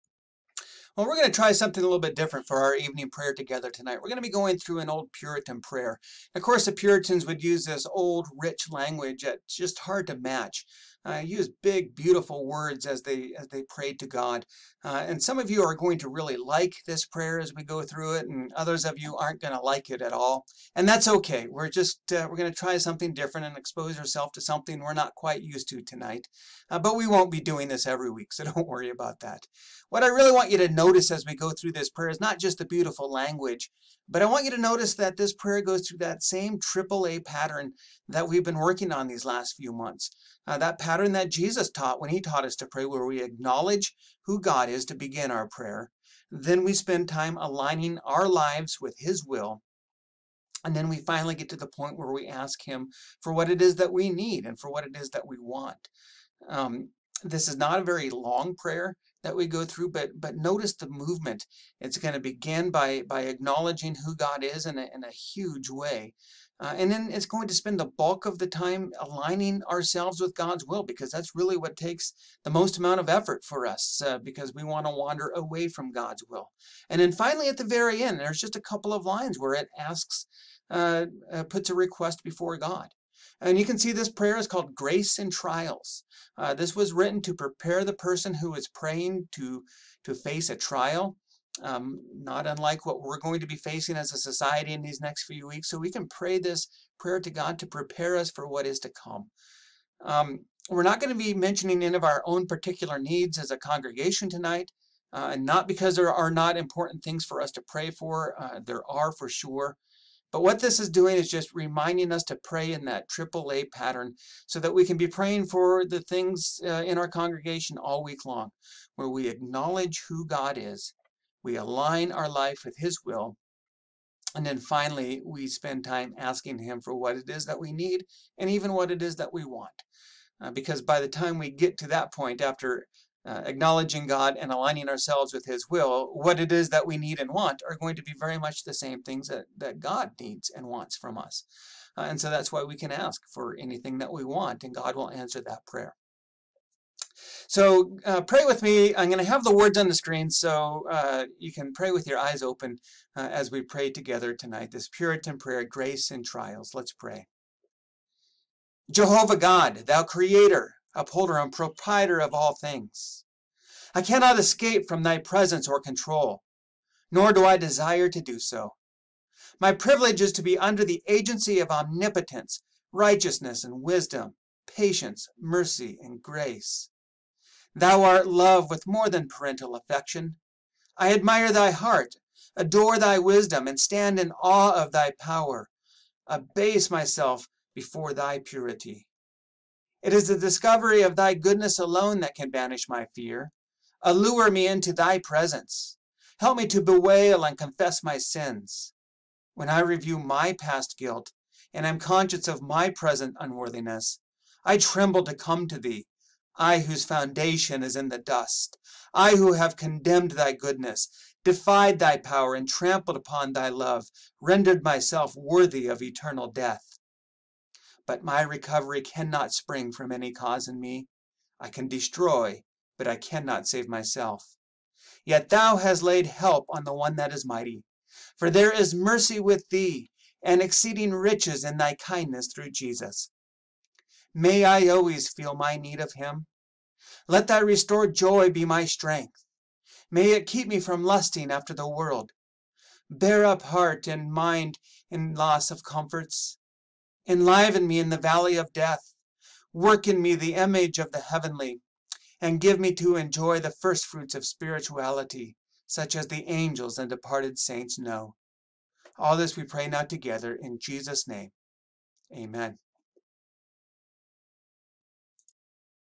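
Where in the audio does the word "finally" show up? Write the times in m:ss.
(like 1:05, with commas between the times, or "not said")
0:50, 1:17, 2:04.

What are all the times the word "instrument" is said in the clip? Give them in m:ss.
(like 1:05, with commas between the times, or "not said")
not said.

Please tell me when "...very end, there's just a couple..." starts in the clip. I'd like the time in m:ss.
1:17.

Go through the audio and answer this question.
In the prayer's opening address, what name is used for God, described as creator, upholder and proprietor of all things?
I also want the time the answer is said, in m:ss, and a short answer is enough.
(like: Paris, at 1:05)
Jehovah God, at 2:38.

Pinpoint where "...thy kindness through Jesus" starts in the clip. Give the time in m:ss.
3:51.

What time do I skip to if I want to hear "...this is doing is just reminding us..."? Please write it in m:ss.
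1:50.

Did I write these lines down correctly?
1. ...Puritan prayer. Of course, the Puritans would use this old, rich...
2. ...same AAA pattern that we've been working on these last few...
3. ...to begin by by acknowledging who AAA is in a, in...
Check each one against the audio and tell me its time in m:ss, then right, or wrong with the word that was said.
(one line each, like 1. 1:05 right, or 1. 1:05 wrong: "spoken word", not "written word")
1. 0:05 right
2. 0:36 right
3. 1:02 wrong: "God", not "AAA".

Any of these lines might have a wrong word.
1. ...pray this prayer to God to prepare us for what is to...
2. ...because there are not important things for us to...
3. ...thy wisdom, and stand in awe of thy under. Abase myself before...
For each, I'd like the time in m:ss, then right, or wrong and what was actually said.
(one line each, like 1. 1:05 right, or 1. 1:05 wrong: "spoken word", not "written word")
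1. 1:36 right
2. 1:45 right
3. 3:02 wrong: "power", not "under".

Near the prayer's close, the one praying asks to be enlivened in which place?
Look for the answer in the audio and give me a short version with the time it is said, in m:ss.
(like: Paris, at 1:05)
the valley of death, at 4:08.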